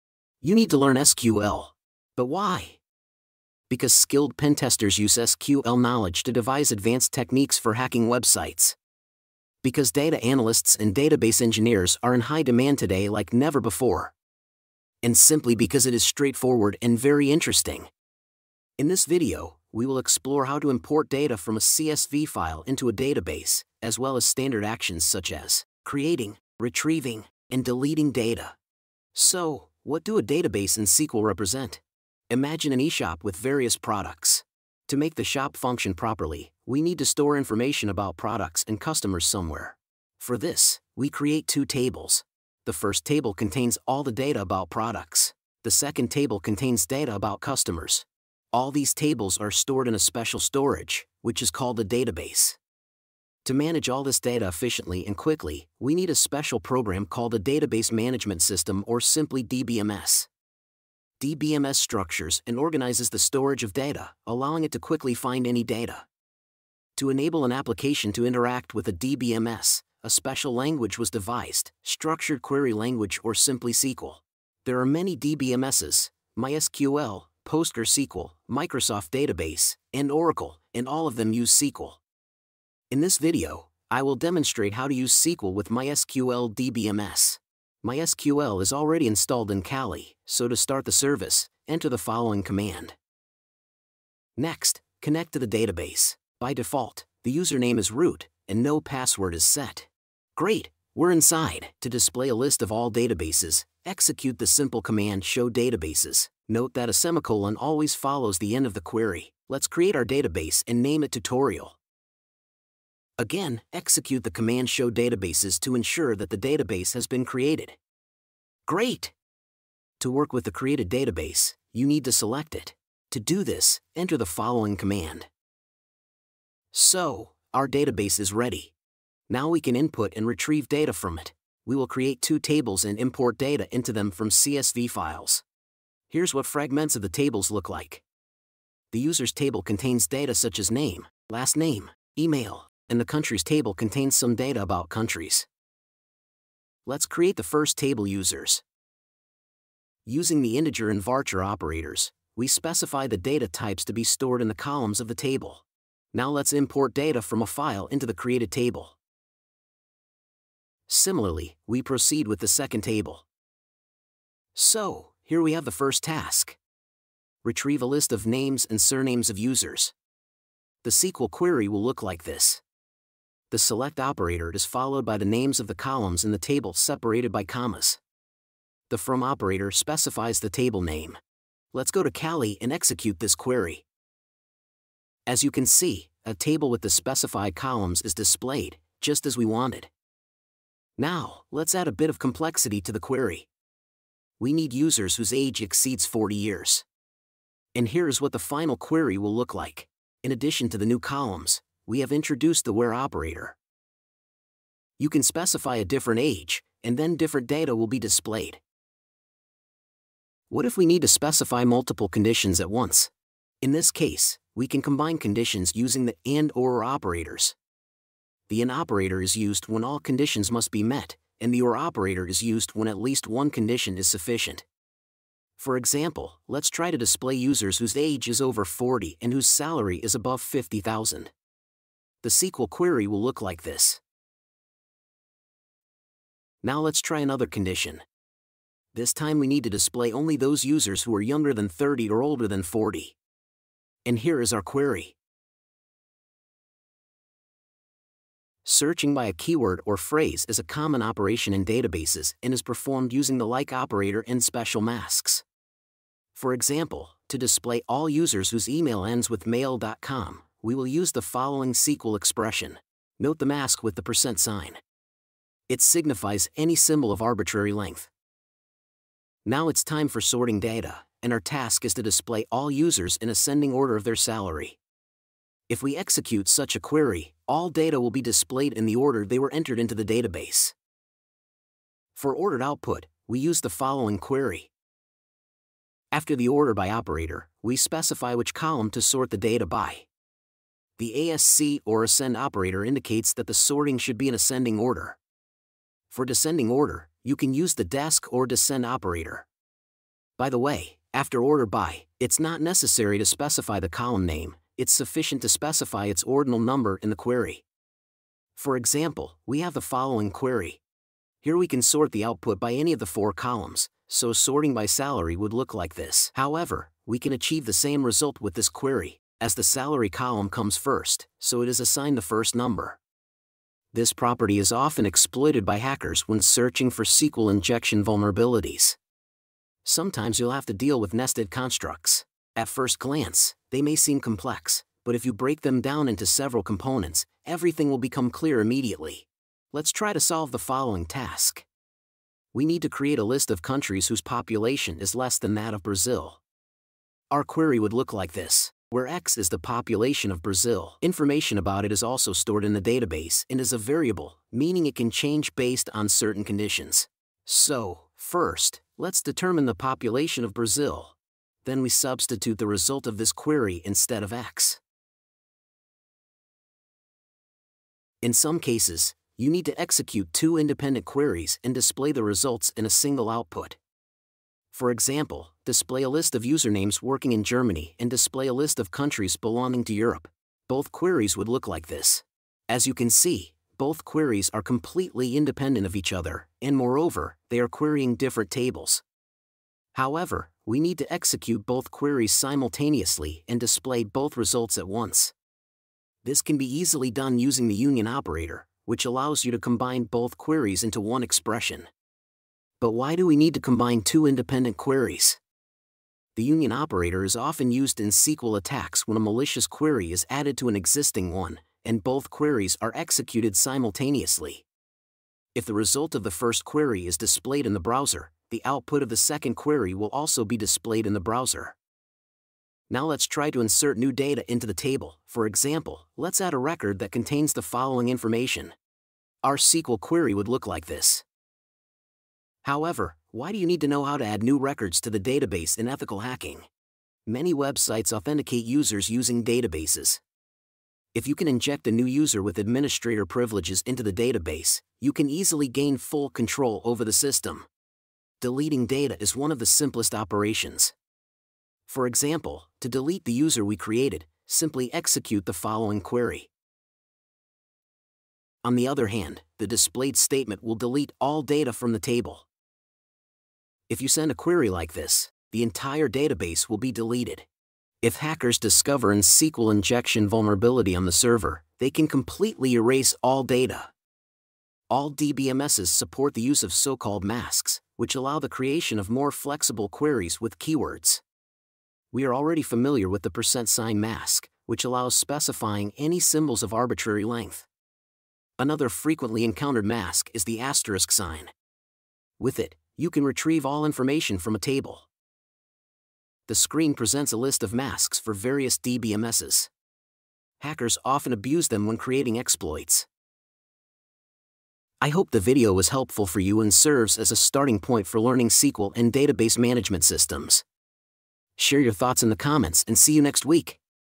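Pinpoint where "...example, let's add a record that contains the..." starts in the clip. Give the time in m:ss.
7:05.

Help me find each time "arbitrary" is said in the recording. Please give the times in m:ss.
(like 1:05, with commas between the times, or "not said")
4:27, 8:06.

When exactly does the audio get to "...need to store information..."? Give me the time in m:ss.
0:36.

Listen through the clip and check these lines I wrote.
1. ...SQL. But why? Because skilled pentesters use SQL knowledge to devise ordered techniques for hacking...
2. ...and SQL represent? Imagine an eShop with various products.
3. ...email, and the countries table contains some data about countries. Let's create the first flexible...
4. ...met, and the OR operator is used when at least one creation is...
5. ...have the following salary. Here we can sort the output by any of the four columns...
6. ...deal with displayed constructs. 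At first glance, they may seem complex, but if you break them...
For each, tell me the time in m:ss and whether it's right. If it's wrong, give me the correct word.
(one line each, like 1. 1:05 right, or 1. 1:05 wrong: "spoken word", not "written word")
1. 0:00 wrong: "advanced", not "ordered"
2. 0:30 right
3. 2:22 wrong: "table", not "flexible"
4. 3:40 wrong: "condition", not "creation"
5. 5:09 wrong: "query", not "salary"
6. 5:30 wrong: "nested", not "displayed".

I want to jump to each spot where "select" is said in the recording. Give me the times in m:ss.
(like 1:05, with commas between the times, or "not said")
2:02, 2:53.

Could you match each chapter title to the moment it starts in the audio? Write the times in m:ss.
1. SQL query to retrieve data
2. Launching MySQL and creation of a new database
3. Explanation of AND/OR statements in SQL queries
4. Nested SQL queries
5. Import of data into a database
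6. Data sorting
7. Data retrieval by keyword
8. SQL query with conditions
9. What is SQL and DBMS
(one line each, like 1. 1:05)
1. 2:44
2. 1:27
3. 3:29
4. 5:29
5. 2:27
6. 4:29
7. 4:08
8. 3:10
9. 0:32.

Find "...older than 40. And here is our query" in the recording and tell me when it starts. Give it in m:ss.
4:02.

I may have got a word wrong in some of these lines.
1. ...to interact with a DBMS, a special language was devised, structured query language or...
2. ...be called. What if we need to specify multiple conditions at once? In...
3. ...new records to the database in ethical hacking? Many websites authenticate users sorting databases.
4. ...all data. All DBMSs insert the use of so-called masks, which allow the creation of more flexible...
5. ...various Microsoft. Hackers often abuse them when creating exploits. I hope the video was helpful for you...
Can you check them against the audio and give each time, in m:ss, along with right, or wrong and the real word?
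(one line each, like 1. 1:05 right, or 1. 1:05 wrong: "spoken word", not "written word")
1. 1:08 right
2. 3:27 wrong: "displayed", not "called"
3. 7:14 wrong: "using", not "sorting"
4. 7:53 wrong: "support", not "insert"
5. 8:18 wrong: "DBMSs", not "Microsoft".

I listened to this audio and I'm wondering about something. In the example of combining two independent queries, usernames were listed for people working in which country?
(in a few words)
Germany.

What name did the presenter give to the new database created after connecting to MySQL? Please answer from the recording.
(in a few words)
tutorial.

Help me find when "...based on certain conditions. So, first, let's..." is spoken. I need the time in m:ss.
5:55.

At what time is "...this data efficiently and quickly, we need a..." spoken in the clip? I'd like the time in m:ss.
0:54.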